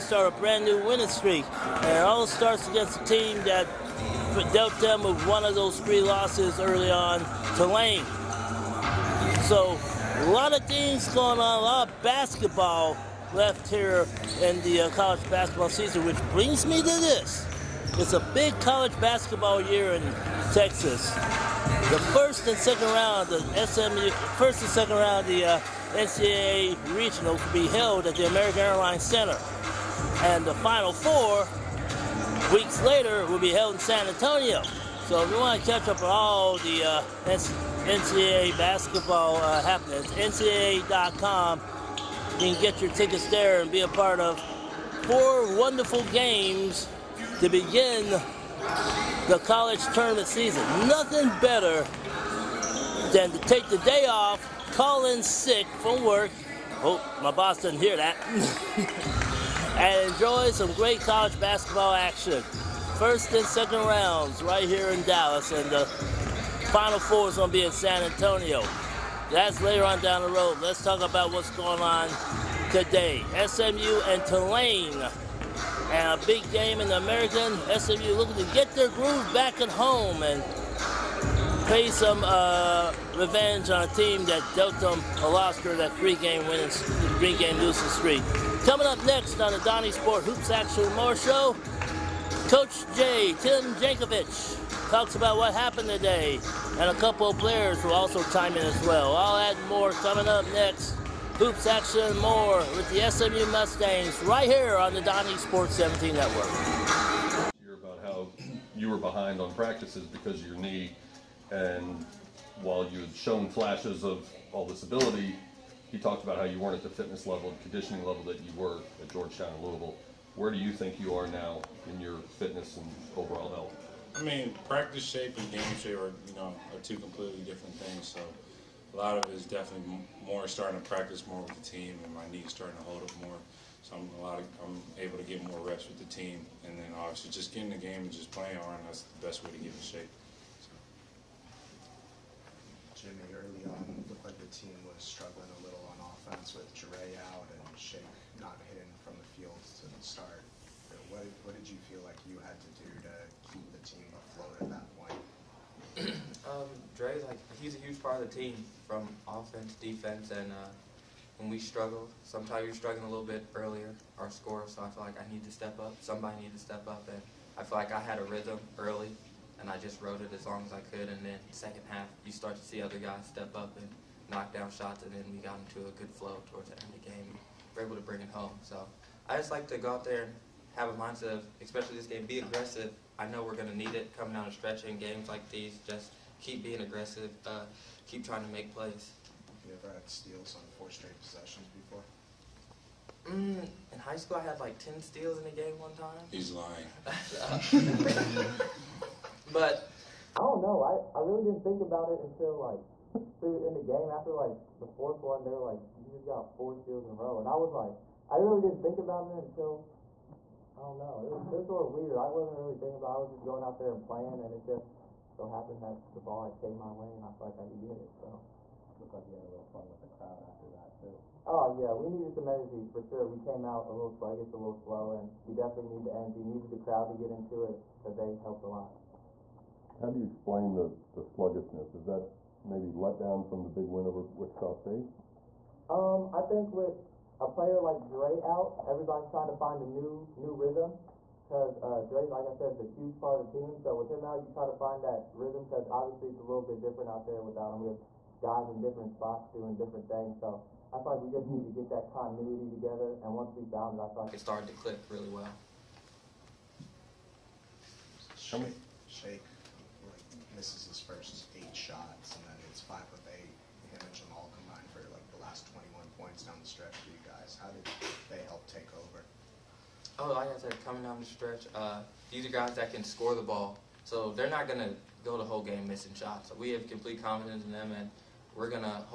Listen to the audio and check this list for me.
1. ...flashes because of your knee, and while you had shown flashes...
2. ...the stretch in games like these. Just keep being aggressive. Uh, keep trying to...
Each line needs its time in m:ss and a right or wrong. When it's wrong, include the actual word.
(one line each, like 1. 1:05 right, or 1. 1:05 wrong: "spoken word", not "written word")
1. 1:49 wrong: "practices", not "flashes"
2. 3:04 right.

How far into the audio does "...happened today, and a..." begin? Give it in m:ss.
1:35.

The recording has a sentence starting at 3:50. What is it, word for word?
How do you explain the, the sluggishness?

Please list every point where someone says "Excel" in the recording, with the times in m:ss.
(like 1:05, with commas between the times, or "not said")
not said.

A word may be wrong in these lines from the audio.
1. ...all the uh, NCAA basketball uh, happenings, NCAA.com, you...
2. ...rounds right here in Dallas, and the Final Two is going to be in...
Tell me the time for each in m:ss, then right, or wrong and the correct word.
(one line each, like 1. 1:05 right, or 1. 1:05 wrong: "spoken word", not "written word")
1. 0:36 right
2. 1:03 wrong: "Four", not "Two".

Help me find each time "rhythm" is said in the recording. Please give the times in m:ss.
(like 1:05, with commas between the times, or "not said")
2:48, 4:00, 4:05.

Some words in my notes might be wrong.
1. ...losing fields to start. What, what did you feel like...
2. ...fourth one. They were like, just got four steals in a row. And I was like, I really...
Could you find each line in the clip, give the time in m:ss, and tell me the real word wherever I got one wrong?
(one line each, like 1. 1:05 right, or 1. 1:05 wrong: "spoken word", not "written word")
1. 2:28 wrong: "hitting", not "losing"
2. 3:24 right.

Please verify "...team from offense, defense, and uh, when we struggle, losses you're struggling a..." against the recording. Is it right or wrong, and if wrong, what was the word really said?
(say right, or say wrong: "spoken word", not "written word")
wrong: "sometimes", not "losses".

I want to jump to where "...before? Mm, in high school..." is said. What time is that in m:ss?
3:11.